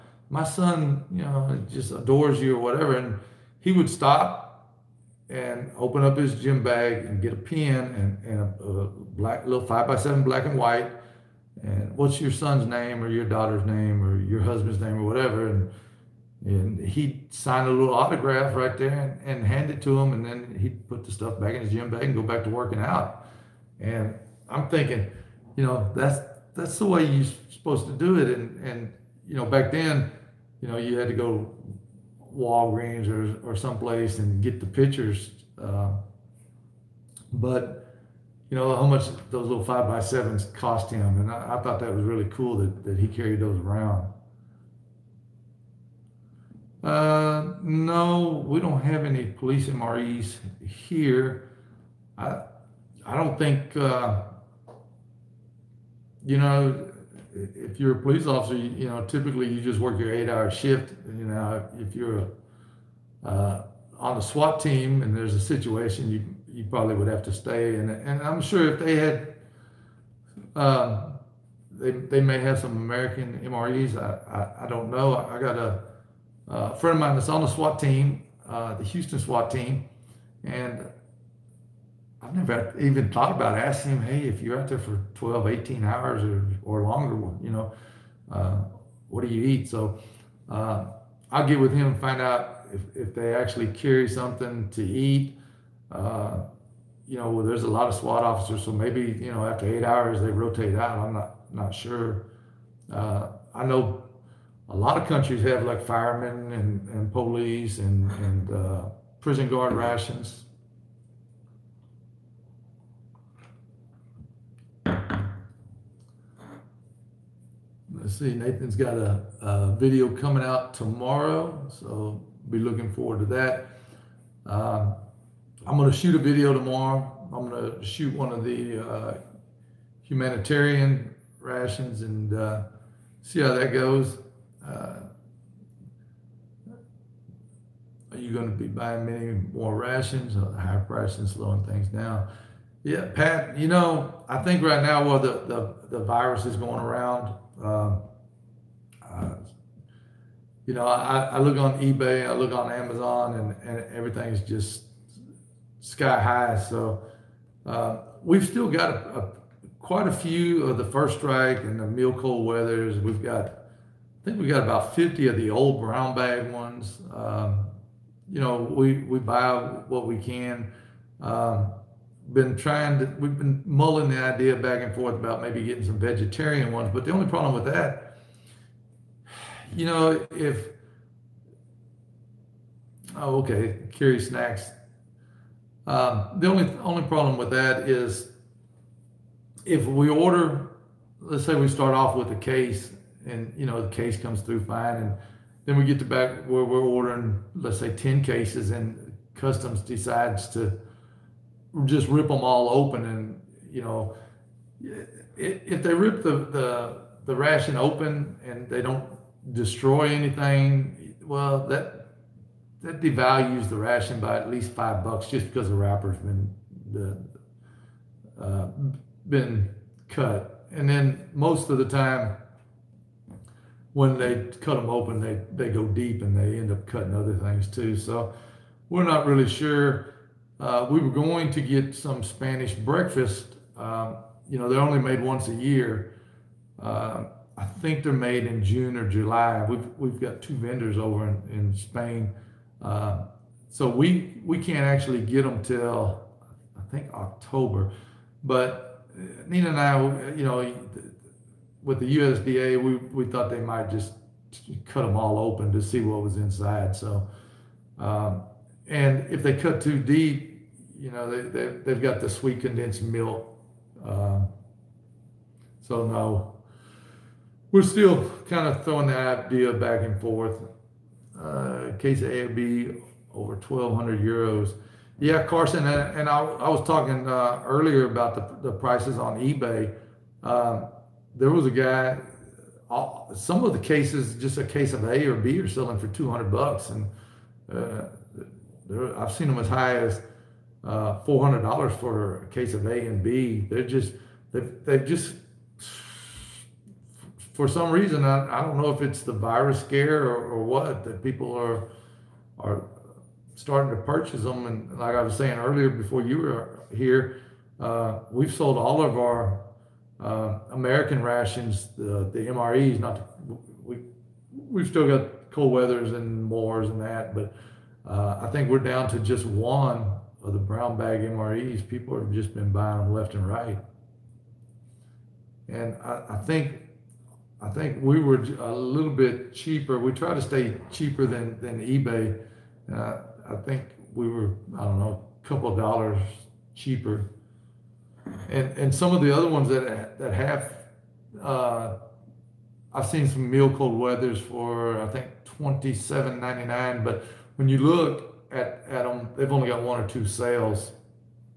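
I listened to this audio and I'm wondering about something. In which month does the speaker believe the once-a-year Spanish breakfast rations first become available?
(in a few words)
October.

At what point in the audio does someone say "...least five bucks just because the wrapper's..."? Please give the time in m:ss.
3:34.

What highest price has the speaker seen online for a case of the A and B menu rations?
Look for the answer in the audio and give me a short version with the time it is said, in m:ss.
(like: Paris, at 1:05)
$400, at 4:51.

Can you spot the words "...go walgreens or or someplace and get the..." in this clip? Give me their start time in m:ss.
0:31.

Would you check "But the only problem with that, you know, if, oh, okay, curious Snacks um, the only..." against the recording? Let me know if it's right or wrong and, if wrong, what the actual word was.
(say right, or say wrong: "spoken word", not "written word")
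right.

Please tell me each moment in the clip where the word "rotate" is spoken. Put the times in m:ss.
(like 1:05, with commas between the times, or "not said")
1:40.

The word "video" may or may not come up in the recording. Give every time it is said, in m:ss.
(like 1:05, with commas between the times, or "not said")
1:59, 2:06.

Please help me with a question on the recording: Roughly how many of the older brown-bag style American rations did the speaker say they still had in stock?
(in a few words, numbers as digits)
50.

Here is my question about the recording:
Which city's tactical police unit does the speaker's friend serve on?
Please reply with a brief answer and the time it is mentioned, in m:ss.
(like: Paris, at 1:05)
Houston, at 1:18.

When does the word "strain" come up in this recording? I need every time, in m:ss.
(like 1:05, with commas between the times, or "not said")
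not said.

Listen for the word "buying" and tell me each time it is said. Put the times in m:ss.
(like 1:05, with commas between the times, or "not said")
2:18, 5:22.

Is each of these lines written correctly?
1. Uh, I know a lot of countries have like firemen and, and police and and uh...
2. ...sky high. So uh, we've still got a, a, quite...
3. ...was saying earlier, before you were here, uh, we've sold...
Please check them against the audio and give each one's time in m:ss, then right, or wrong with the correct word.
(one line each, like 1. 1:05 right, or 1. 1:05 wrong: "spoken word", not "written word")
1. 1:42 right
2. 2:35 right
3. 5:05 right.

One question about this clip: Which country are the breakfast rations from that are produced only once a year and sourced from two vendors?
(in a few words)
Spain.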